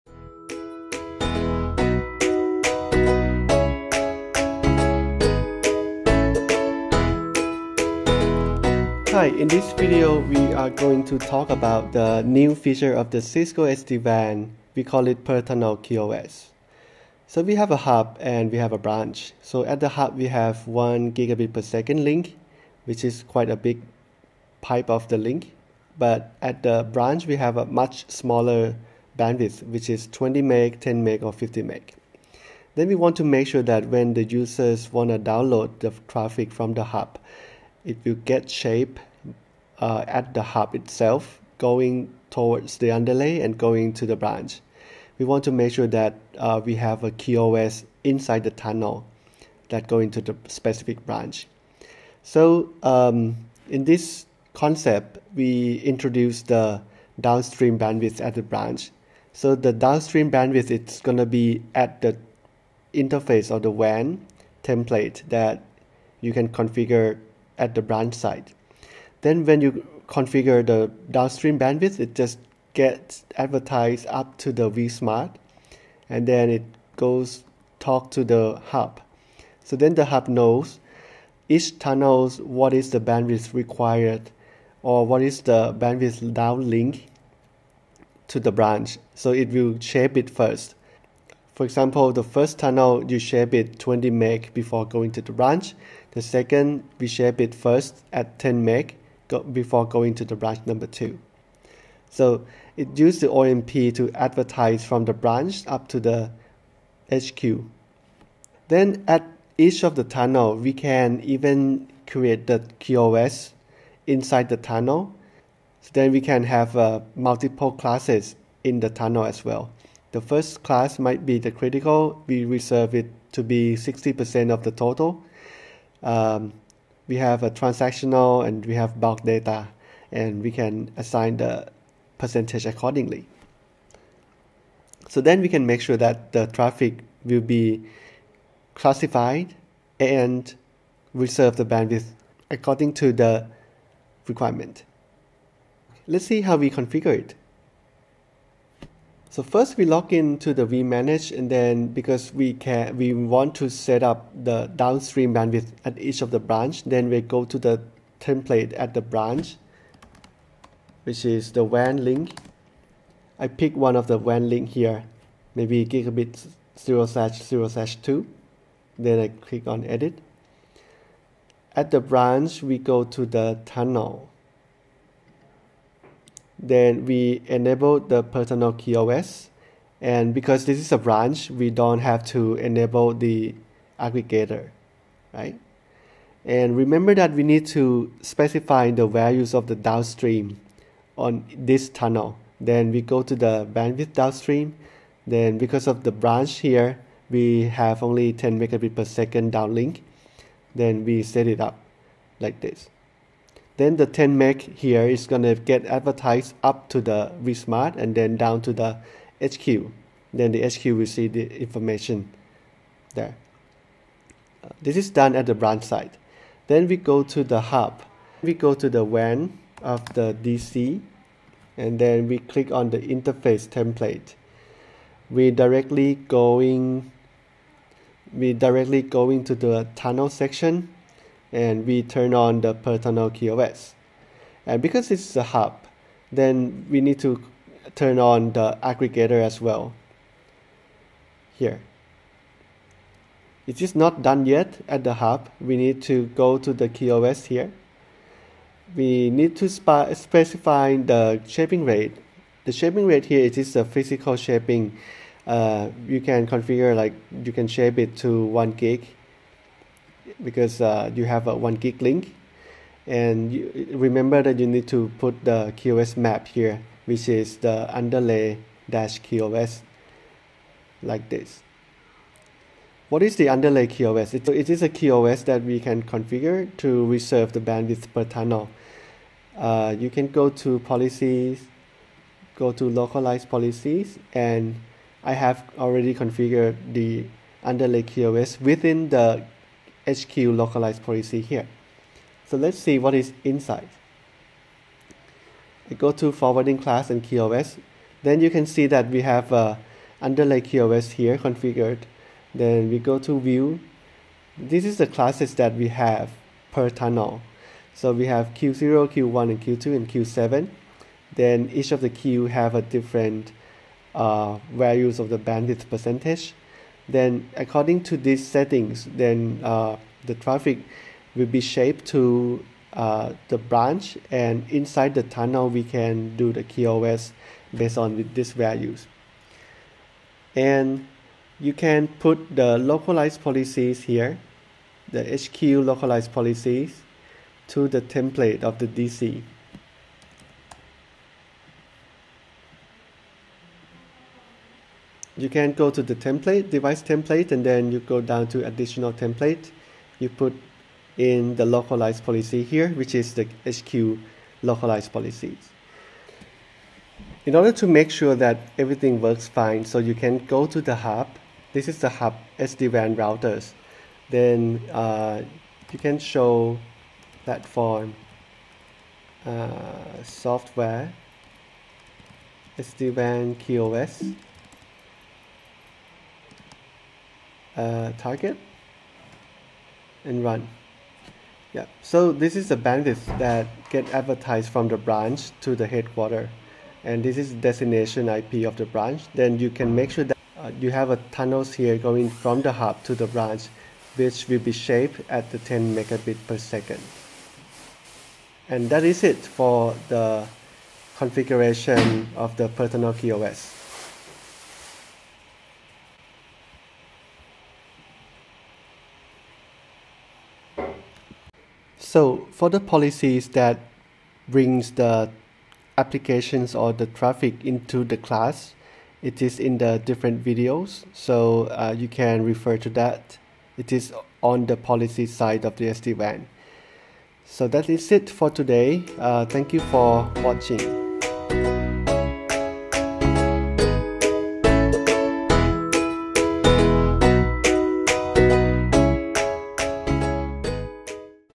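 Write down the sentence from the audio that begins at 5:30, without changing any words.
And you can put the localized policies here, the HQ localized policies to the template of the DC.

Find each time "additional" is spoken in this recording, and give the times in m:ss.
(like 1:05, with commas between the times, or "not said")
5:48.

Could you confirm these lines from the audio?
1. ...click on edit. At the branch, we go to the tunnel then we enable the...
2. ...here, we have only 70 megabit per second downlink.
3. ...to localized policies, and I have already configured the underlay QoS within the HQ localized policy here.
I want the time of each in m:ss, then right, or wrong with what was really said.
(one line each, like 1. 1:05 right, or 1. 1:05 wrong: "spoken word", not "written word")
1. 2:49 right
2. 3:16 wrong: "10", not "70"
3. 4:42 right.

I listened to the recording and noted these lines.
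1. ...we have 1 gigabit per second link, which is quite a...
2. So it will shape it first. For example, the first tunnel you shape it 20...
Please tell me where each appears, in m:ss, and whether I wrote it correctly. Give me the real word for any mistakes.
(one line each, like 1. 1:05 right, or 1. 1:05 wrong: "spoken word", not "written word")
1. 0:20 right
2. 1:29 right.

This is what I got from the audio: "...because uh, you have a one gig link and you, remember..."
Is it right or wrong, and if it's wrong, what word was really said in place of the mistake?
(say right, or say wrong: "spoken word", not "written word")
right.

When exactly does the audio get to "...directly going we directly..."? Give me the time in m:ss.
3:45.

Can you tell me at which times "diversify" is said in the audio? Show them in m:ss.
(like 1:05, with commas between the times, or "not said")
not said.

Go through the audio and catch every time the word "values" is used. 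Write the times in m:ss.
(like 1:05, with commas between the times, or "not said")
3:09, 5:14, 5:28.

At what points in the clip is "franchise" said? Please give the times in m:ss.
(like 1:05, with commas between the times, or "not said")
not said.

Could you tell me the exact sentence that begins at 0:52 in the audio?
So um, in this concept, we introduce the downstream bandwidth at the branch.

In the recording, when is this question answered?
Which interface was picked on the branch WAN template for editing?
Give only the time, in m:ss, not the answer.
2:45.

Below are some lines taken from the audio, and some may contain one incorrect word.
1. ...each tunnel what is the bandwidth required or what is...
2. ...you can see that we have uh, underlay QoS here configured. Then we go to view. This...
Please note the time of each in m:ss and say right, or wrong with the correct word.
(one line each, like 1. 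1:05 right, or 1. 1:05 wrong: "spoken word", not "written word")
1. 1:21 right
2. 4:58 right.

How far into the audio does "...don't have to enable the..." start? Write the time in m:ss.
3:01.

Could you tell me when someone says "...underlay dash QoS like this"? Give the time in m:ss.
4:27.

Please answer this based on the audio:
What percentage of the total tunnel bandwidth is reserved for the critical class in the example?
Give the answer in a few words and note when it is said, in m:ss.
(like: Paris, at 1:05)
60%, at 2:03.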